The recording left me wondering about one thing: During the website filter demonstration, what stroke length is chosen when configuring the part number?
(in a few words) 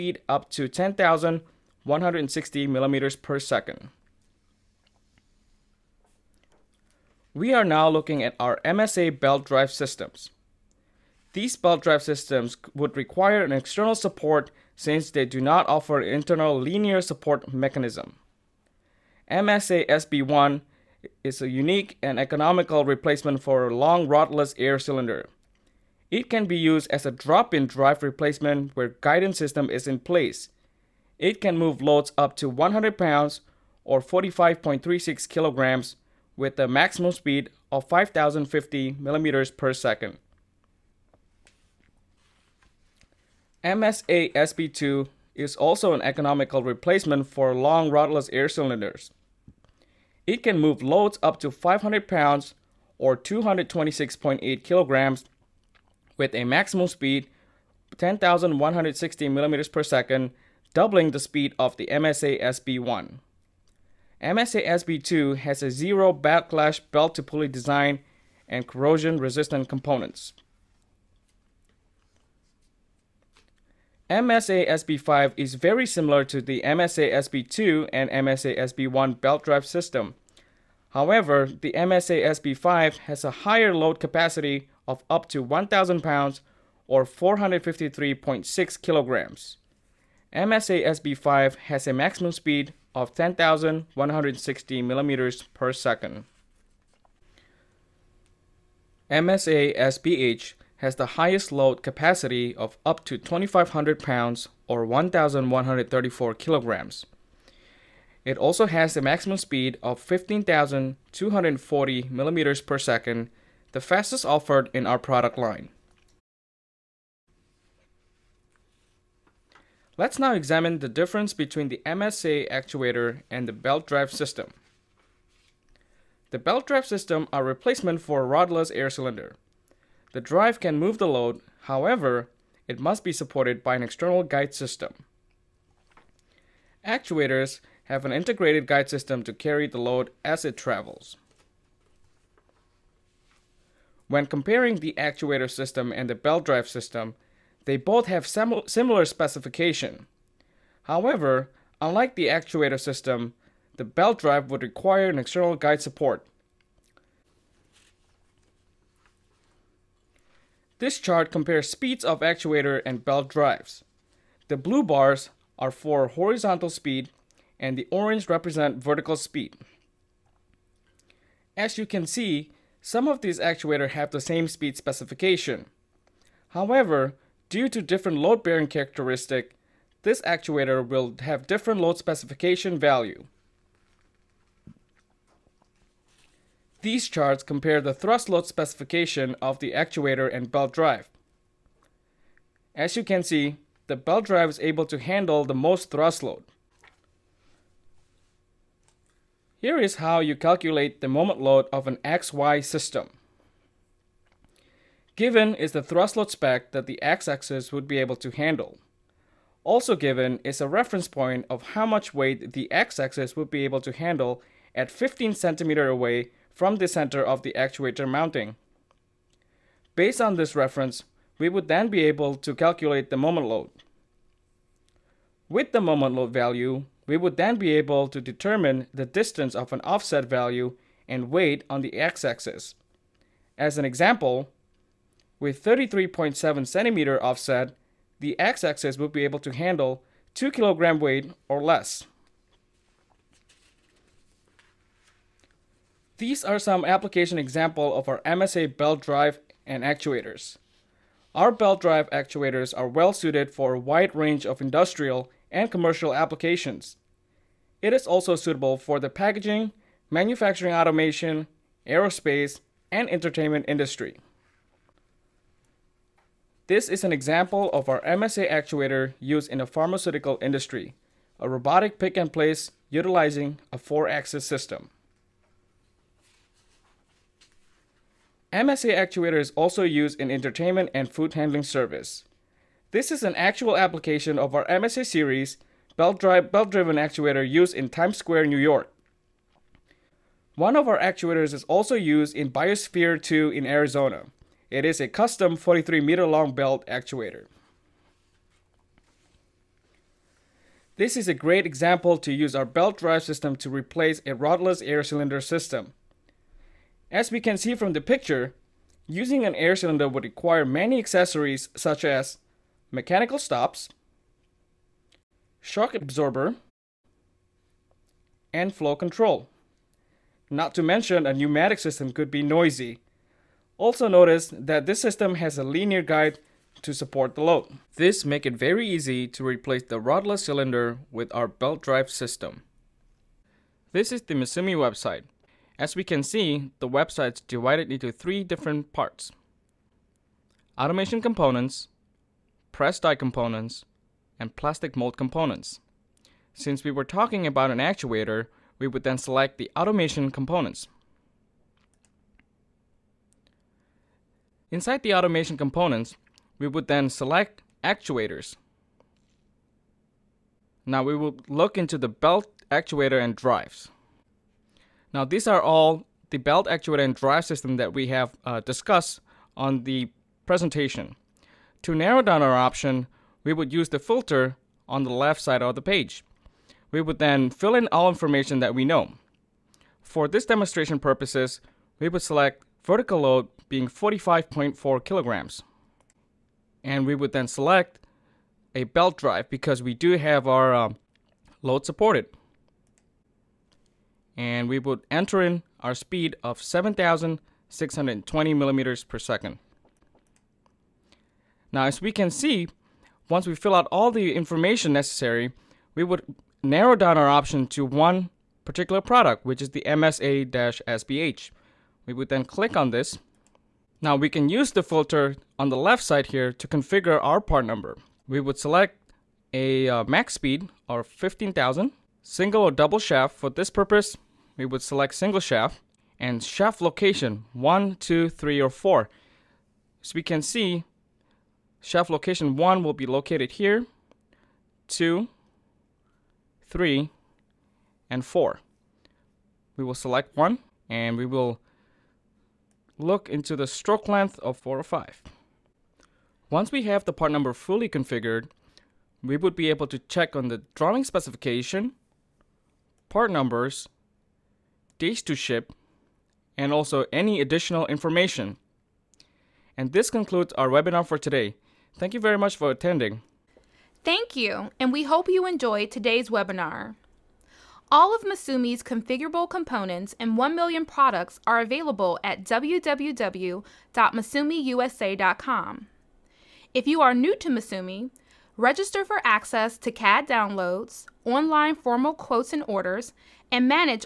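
405.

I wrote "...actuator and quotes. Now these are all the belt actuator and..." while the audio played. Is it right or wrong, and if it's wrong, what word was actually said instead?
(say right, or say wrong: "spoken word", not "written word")
wrong: "drives", not "quotes".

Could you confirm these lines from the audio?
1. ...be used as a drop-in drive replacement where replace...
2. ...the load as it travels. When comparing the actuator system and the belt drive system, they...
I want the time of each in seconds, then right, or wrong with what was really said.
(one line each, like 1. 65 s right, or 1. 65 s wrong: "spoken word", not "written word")
1. 26 s wrong: "guidance", not "replace"
2. 139 s right.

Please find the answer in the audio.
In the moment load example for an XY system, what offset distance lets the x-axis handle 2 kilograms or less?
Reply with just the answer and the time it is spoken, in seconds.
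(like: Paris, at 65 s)
33.7 centimeters, at 235 s.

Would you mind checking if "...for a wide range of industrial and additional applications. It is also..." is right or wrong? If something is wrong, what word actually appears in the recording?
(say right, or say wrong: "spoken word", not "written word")
wrong: "commercial", not "additional".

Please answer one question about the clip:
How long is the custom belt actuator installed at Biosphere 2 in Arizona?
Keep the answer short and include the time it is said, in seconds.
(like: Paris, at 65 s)
43 meters, at 295 s.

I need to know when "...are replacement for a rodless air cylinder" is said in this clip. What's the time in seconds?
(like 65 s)
127 s.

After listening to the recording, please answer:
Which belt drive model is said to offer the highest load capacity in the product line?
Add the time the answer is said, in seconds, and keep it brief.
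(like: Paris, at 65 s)
MSA SBH, at 99 s.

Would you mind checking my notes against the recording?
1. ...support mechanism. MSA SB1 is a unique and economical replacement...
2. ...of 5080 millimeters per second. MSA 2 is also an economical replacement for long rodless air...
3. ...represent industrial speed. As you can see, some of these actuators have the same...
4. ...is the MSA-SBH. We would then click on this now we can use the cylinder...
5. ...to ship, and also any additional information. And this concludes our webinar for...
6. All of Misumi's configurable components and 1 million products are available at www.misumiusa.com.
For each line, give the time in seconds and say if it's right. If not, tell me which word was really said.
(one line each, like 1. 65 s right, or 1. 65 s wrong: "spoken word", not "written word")
1. 17 s right
2. 37 s wrong: "5050", not "5080"
3. 168 s wrong: "vertical", not "industrial"
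4. 409 s wrong: "filter", not "cylinder"
5. 455 s right
6. 467 s right.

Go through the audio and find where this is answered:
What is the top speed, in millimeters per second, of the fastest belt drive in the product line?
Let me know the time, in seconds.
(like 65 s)
109 s.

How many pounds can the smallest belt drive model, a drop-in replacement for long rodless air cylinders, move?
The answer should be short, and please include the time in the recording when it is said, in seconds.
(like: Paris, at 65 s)
100 pounds, at 32 s.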